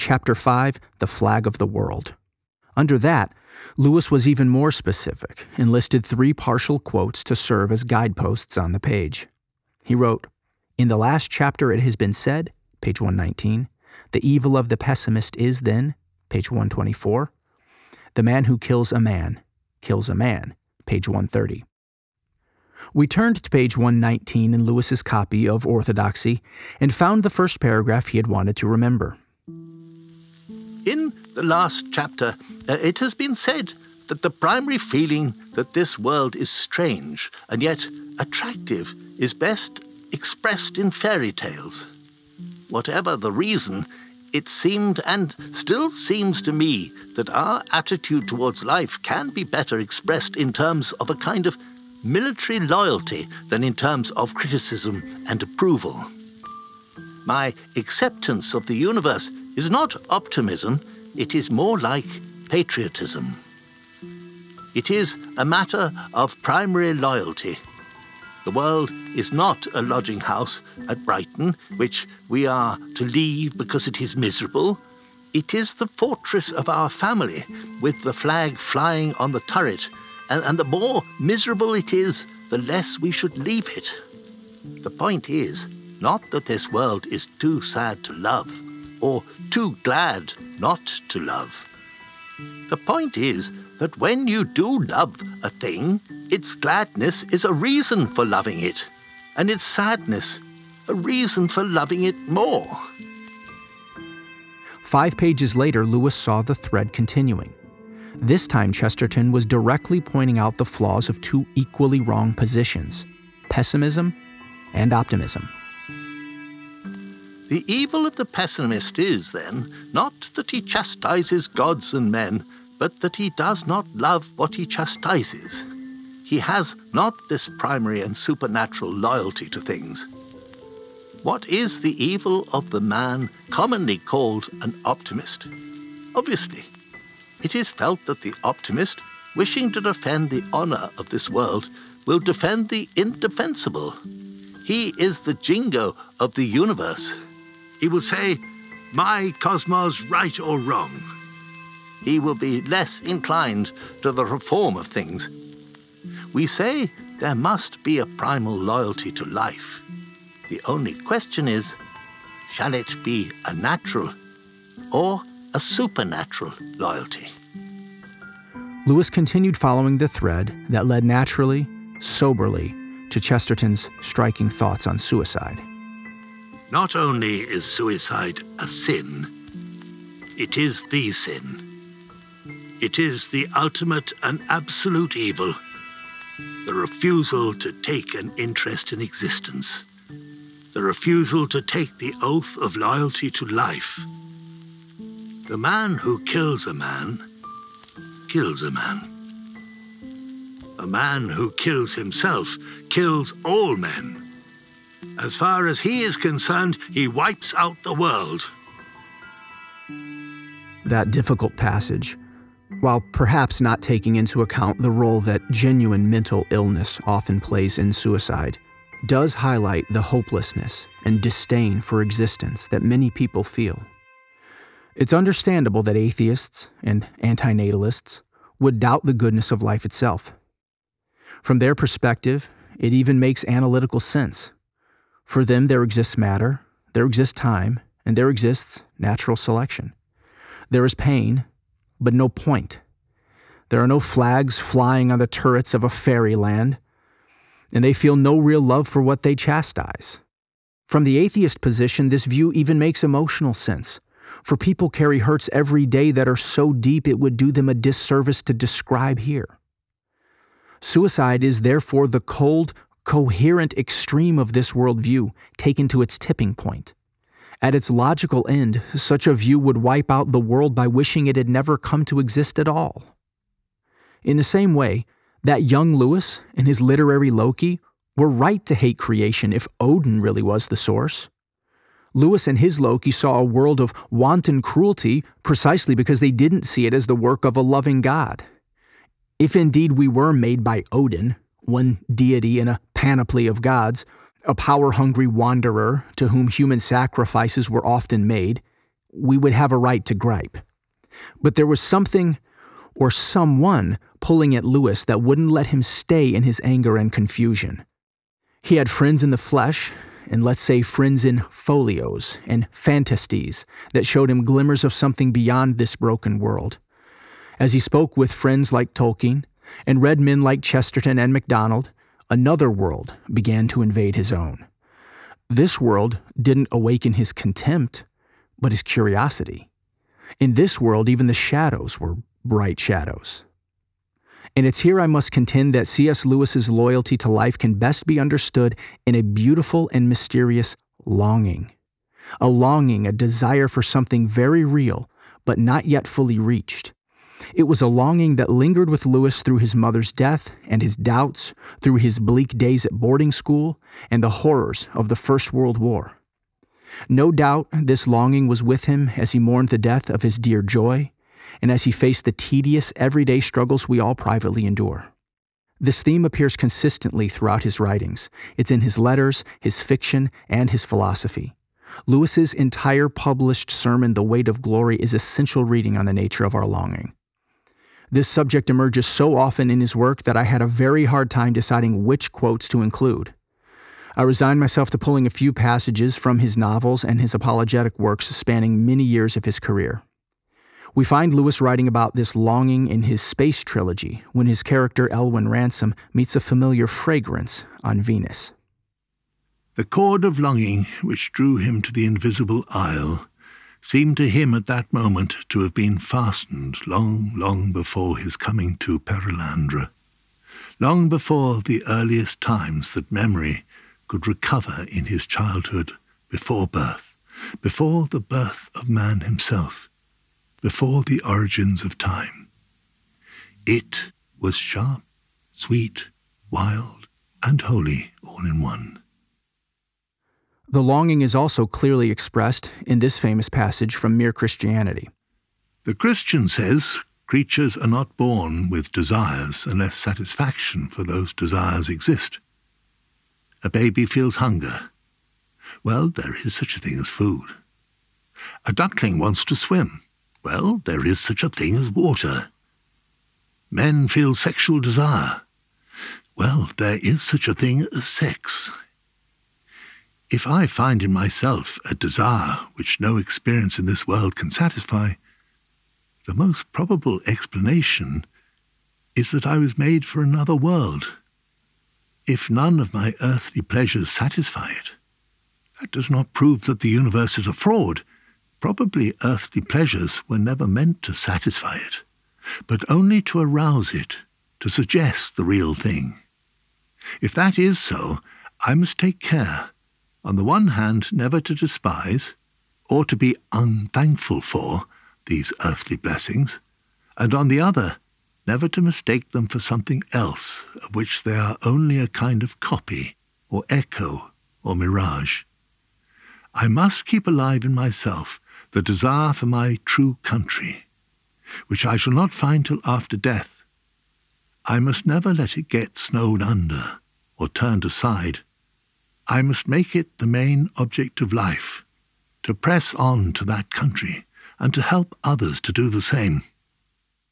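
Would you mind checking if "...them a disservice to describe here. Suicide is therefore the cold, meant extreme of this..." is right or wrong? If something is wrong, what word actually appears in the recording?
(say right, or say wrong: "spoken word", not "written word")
wrong: "coherent", not "meant".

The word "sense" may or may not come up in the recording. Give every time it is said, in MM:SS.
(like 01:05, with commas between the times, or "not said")
03:54, 04:13.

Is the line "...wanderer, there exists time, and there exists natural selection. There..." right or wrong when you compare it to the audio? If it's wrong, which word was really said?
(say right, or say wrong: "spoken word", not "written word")
wrong: "matter", not "wanderer".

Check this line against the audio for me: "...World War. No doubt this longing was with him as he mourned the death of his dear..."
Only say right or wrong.
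right.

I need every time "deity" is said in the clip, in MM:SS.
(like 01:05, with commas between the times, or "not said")
04:52.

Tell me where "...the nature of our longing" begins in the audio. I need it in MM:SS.
06:16.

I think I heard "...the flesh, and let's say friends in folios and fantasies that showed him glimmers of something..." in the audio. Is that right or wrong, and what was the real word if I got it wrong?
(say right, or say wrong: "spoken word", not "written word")
right.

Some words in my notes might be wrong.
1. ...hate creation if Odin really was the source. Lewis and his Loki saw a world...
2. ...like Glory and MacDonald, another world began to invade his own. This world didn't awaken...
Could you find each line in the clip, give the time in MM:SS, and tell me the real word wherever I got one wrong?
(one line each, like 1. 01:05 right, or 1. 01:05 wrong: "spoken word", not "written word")
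1. 04:38 right
2. 05:20 wrong: "Chesterton", not "Glory".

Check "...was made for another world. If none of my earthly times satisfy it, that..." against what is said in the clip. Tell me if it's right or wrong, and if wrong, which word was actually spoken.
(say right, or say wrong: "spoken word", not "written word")
wrong: "pleasures", not "times".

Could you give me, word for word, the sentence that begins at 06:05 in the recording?
This theme appears consistently throughout his writings.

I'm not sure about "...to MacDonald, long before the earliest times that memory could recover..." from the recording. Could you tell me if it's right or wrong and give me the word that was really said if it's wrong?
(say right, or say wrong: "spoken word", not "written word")
wrong: "Perelandra", not "MacDonald".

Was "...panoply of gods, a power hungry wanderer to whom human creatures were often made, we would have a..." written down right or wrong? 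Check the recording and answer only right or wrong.
wrong.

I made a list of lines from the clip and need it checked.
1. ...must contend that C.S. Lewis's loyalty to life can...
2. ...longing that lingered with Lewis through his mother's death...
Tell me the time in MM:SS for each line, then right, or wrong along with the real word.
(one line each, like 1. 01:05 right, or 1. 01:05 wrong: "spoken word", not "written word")
1. 05:35 right
2. 05:47 right.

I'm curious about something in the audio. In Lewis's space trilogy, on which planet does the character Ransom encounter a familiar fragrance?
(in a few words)
Venus.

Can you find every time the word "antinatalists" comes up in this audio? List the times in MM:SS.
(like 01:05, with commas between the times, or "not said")
03:47.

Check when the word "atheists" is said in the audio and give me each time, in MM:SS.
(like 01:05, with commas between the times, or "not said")
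03:45, 04:11.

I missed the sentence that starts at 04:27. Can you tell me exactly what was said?
At its logical end, such a view would wipe out the world by wishing it had never come to exist at all.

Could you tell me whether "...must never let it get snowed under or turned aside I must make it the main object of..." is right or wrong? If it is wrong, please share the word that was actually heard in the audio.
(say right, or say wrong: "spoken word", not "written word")
right.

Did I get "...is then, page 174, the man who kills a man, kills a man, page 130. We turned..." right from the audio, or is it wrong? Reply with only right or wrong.
wrong.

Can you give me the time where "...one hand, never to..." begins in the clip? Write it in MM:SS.
08:10.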